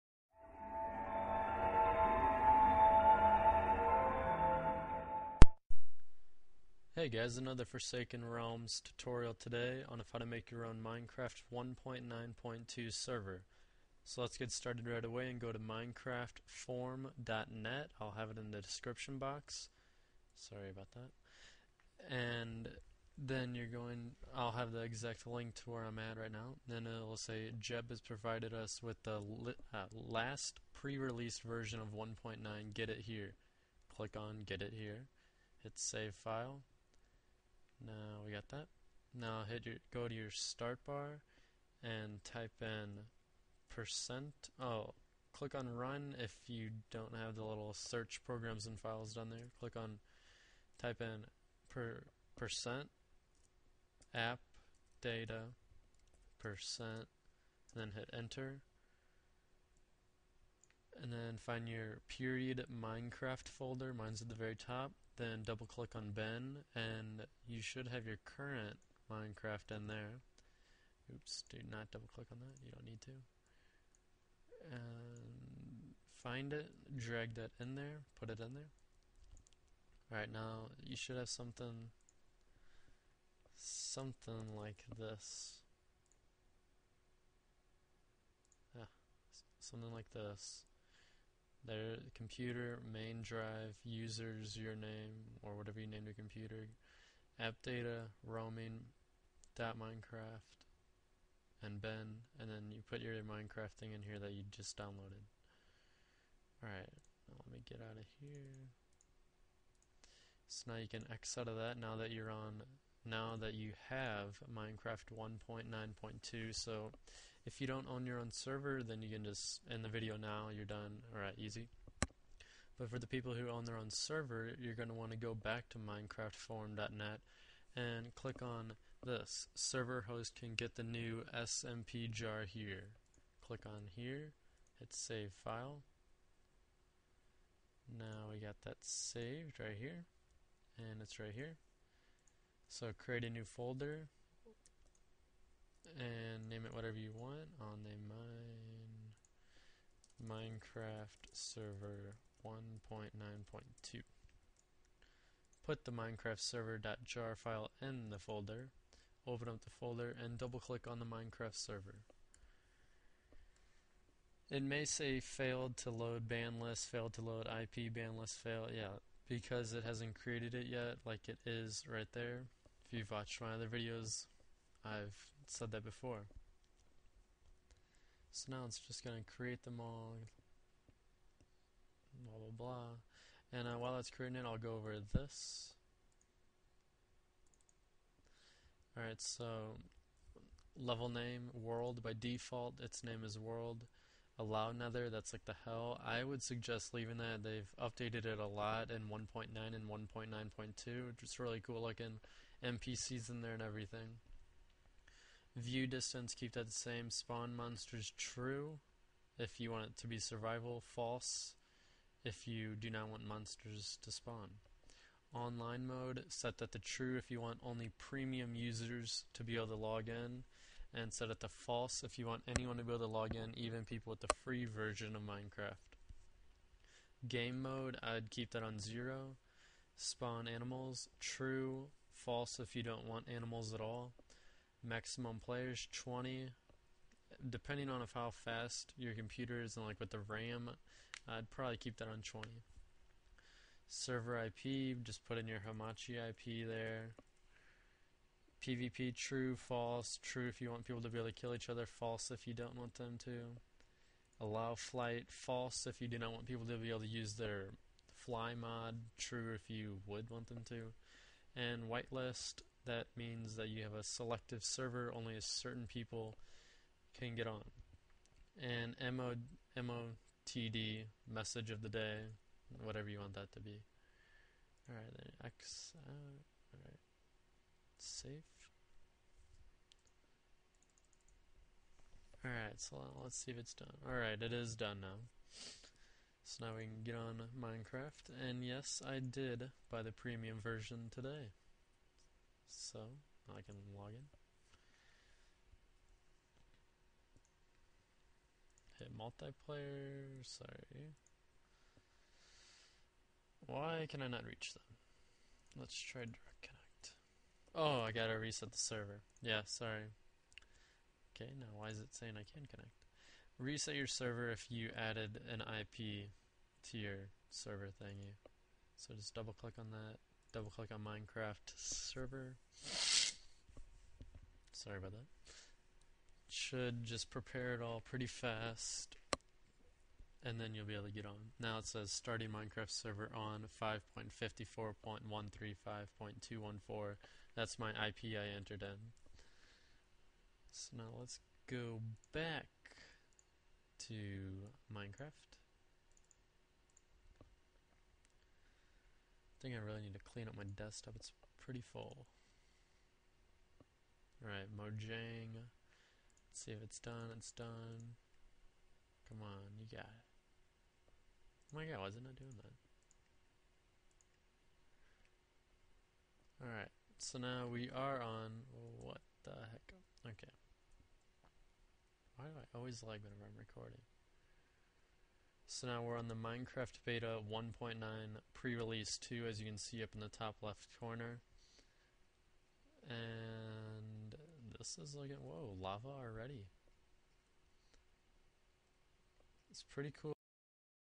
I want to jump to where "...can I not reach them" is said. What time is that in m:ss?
5:04.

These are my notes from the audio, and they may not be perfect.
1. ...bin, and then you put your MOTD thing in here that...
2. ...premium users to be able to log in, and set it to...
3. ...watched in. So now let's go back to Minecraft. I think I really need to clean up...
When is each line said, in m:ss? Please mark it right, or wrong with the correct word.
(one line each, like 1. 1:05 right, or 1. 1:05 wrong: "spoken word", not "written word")
1. 1:41 wrong: "Minecraft", not "MOTD"
2. 3:37 right
3. 5:38 wrong: "entered", not "watched".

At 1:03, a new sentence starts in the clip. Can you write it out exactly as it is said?
Mine's at the very top then double click on bin, and you should have your current Minecraft in there.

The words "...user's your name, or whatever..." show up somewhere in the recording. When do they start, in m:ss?
1:33.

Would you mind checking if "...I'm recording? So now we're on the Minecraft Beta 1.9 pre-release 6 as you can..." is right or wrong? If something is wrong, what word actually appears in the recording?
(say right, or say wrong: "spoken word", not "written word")
wrong: "2", not "6".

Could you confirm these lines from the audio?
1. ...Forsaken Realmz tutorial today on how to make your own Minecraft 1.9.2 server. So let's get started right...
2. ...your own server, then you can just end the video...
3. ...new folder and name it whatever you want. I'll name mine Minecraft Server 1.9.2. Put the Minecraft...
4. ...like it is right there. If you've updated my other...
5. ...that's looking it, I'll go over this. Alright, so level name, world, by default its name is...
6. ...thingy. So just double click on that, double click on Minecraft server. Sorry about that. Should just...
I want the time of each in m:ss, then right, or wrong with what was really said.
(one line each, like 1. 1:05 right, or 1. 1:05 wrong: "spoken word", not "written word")
1. 0:07 right
2. 1:58 right
3. 2:23 right
4. 2:51 wrong: "watched", not "updated"
5. 3:03 wrong: "creating", not "looking"
6. 5:18 right.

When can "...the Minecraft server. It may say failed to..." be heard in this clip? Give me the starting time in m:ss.
2:40.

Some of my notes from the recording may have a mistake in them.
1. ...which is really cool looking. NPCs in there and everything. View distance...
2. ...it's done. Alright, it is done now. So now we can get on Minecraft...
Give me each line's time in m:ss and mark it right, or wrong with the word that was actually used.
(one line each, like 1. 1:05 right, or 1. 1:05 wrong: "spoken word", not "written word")
1. 3:21 right
2. 4:43 right.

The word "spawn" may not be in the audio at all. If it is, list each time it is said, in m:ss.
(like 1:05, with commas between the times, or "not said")
3:27, 3:34, 3:49.